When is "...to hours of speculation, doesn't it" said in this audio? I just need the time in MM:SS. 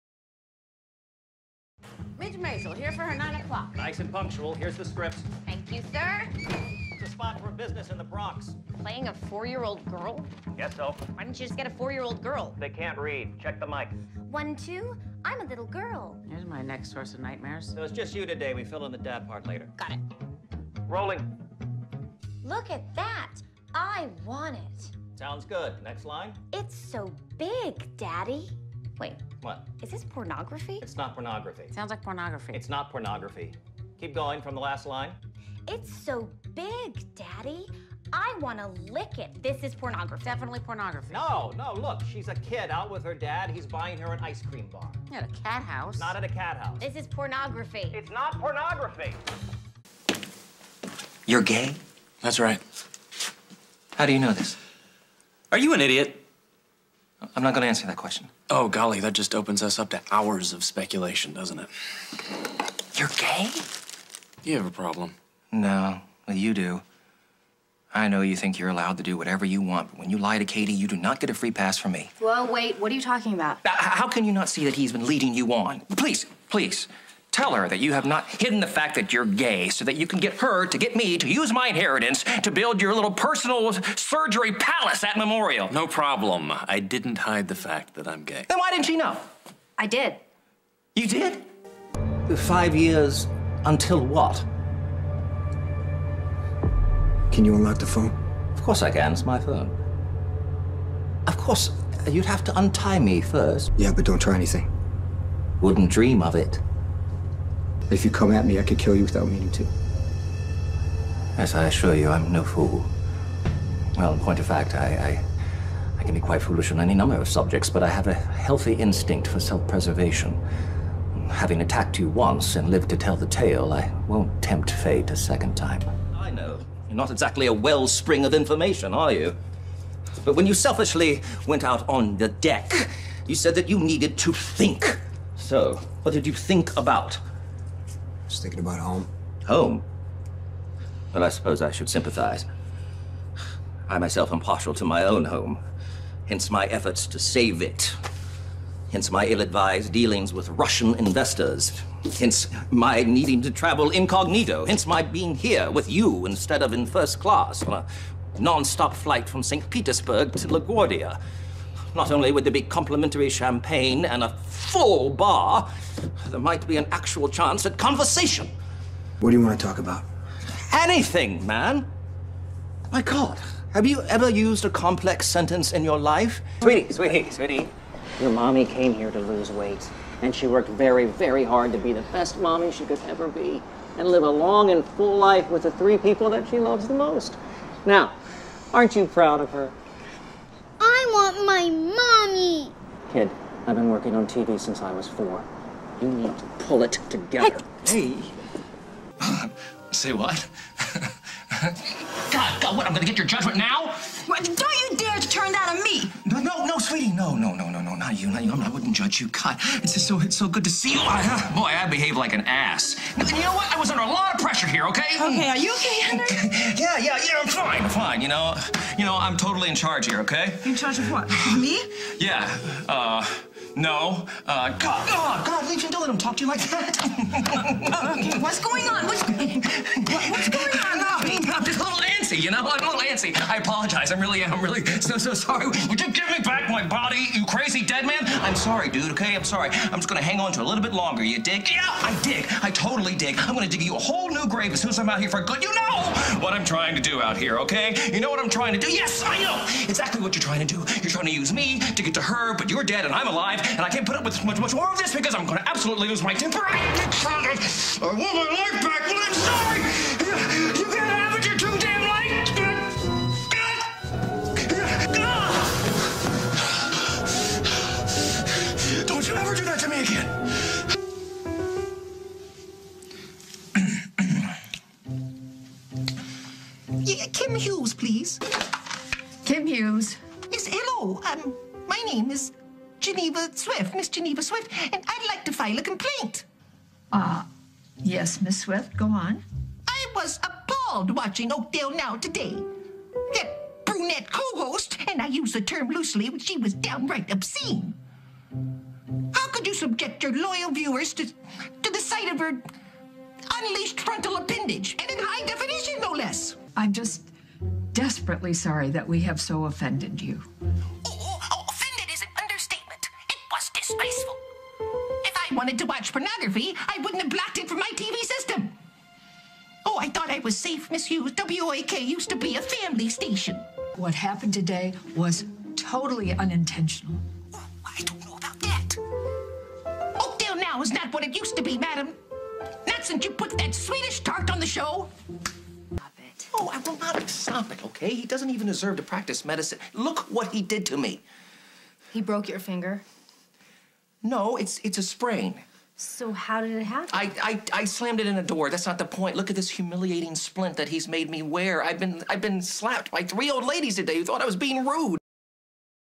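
00:59.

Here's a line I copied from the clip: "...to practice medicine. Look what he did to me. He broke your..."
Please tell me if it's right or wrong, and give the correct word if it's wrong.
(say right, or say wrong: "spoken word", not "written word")
right.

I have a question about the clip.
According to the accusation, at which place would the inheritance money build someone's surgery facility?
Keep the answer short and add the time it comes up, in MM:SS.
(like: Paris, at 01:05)
Memorial, at 01:25.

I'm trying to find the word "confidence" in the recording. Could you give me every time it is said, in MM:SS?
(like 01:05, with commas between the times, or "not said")
not said.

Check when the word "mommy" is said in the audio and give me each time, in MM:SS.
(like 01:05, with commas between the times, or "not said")
02:58, 03:02, 03:11.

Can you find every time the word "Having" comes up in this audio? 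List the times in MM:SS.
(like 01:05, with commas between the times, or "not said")
02:01.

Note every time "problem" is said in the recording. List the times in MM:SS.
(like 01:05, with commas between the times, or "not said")
01:04, 01:25.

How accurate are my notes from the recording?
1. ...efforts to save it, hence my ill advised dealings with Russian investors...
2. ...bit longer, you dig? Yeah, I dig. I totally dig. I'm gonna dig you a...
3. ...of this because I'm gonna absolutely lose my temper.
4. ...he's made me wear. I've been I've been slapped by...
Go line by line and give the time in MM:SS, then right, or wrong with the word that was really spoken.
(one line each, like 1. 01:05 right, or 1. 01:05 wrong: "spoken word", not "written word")
1. 02:26 right
2. 04:00 right
3. 04:14 right
4. 05:50 right.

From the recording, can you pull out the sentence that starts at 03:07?
Now, aren't you proud of her?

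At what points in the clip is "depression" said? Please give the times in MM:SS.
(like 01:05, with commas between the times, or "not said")
not said.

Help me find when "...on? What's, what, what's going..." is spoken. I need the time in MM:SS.
03:48.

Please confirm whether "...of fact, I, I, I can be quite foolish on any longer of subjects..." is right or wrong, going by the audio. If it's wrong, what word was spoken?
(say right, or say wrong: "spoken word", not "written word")
wrong: "number", not "longer".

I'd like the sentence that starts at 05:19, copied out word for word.
Oh, I thought I was safe, Miss Hughes.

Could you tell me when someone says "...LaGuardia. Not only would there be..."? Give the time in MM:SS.
02:40.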